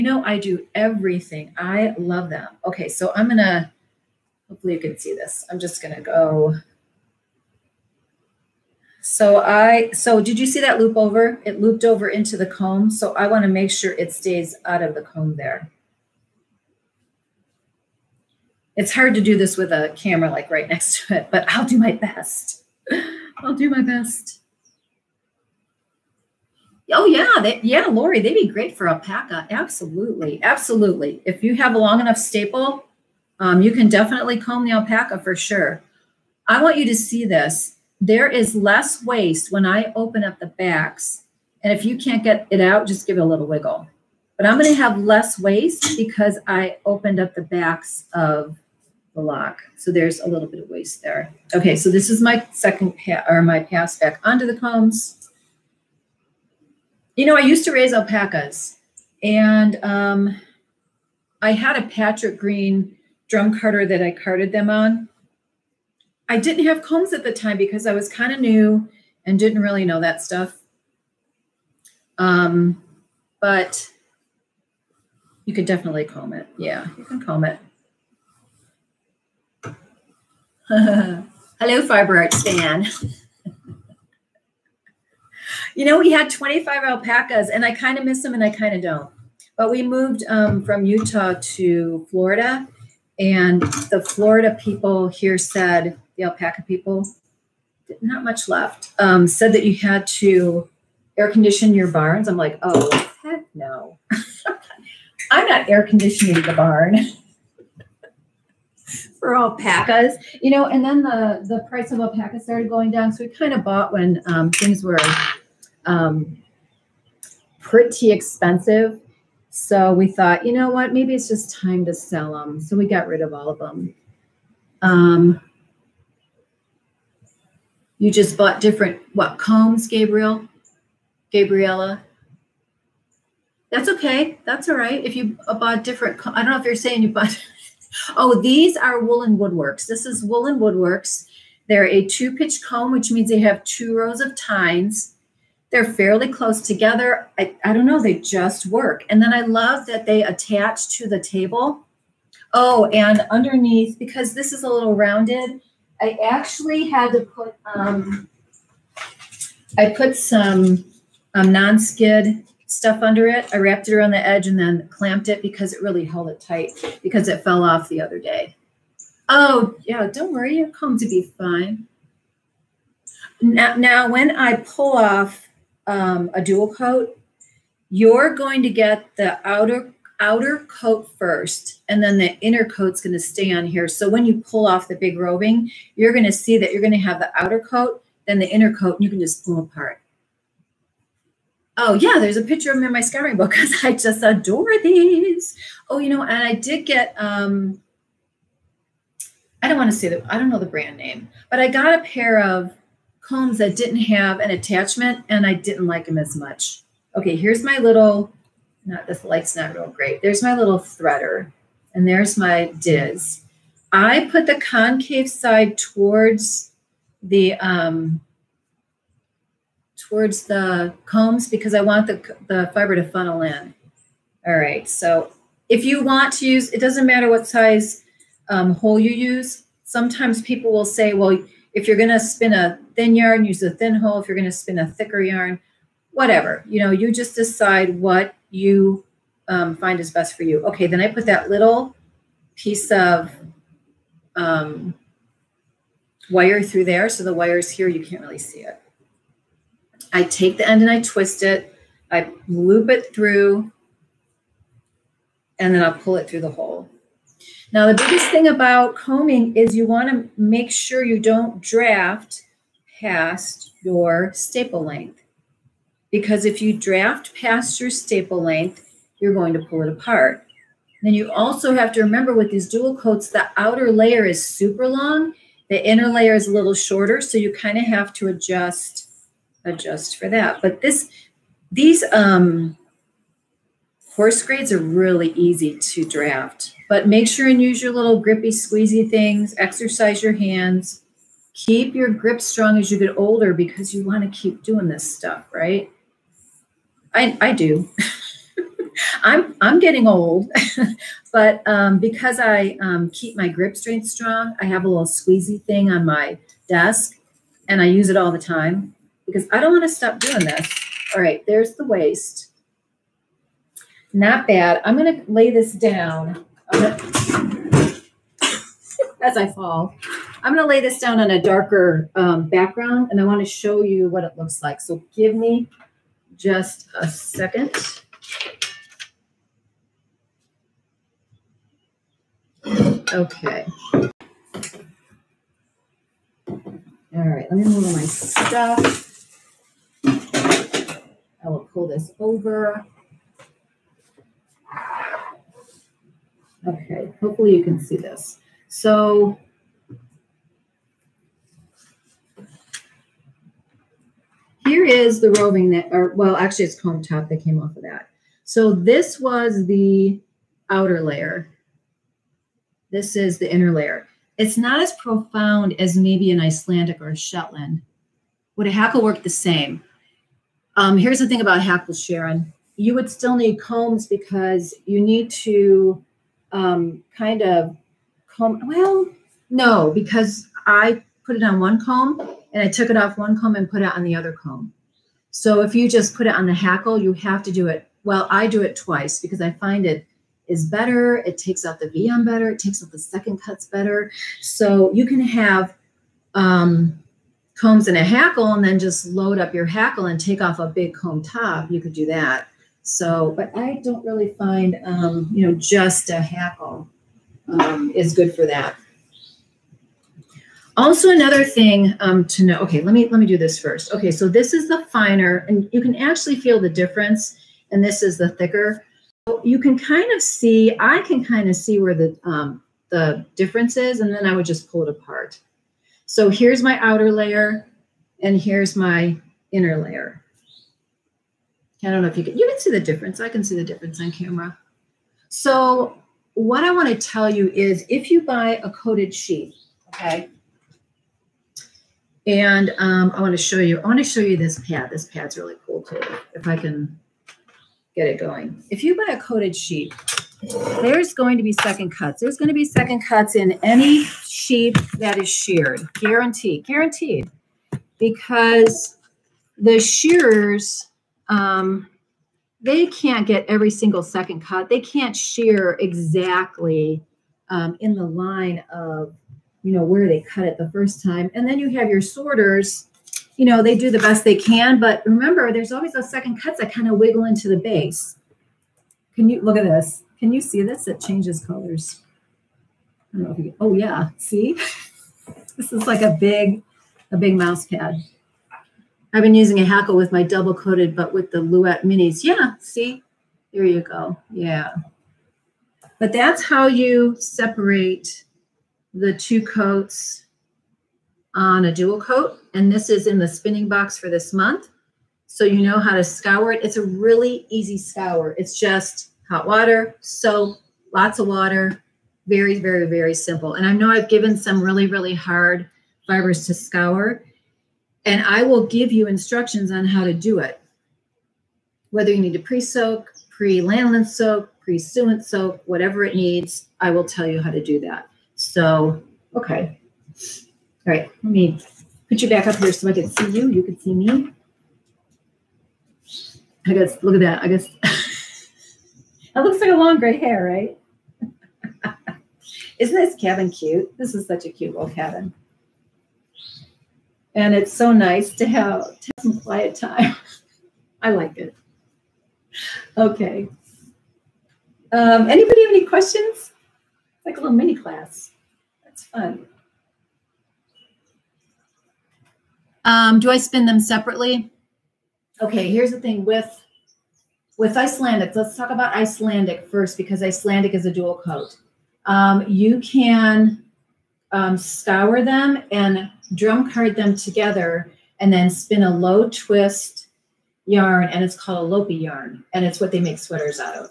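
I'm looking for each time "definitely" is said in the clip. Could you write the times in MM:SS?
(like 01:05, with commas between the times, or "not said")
00:33, 01:15.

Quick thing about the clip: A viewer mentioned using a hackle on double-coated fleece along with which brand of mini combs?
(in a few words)
Louet.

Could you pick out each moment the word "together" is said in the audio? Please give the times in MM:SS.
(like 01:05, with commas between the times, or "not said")
02:26, 09:37.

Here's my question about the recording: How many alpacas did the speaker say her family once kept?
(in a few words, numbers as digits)
25.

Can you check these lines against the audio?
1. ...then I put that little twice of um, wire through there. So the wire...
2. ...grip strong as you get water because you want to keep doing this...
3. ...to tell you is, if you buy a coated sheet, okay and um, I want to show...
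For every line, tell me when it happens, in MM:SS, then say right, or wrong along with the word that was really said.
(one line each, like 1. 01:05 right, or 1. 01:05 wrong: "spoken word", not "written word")
1. 04:00 wrong: "piece", not "twice"
2. 04:52 wrong: "older", not "water"
3. 07:16 right.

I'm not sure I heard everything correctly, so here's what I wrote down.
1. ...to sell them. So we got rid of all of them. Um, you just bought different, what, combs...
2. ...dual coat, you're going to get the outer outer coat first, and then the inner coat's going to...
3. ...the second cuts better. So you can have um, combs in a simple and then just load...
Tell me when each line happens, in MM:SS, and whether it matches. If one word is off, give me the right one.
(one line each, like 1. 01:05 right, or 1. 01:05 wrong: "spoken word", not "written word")
1. 02:01 right
2. 02:56 right
3. 06:32 wrong: "hackle", not "simple".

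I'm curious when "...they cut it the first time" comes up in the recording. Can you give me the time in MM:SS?
07:50.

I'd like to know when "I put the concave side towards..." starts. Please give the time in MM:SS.
03:33.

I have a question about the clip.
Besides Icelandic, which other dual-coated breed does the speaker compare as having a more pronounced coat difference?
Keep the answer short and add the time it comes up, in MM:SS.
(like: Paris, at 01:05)
Shetland, at 06:07.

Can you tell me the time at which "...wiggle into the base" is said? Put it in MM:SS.
07:56.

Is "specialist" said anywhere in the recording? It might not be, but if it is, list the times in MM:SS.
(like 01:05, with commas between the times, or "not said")
not said.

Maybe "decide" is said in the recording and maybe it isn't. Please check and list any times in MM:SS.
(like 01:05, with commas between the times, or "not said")
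03:57.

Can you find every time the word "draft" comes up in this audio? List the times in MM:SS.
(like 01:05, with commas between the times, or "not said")
04:21, 04:26, 04:46.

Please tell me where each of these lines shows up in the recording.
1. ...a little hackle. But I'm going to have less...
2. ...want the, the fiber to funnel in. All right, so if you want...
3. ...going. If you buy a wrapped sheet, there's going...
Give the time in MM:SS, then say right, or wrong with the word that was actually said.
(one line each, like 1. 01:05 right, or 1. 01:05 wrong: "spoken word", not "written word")
1. 00:43 wrong: "wiggle", not "hackle"
2. 03:41 right
3. 07:28 wrong: "coated", not "wrapped".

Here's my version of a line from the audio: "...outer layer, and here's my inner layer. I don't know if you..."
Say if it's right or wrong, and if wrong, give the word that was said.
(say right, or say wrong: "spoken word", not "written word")
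right.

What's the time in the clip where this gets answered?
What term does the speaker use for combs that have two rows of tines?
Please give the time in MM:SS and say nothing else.
02:22.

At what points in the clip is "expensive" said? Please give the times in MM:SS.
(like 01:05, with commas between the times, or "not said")
01:58.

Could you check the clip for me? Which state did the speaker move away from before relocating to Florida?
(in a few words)
Utah.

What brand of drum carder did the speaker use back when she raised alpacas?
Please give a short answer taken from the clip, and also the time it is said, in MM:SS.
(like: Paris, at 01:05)
Patrick Green, at 01:01.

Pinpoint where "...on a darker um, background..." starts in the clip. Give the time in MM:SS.
05:21.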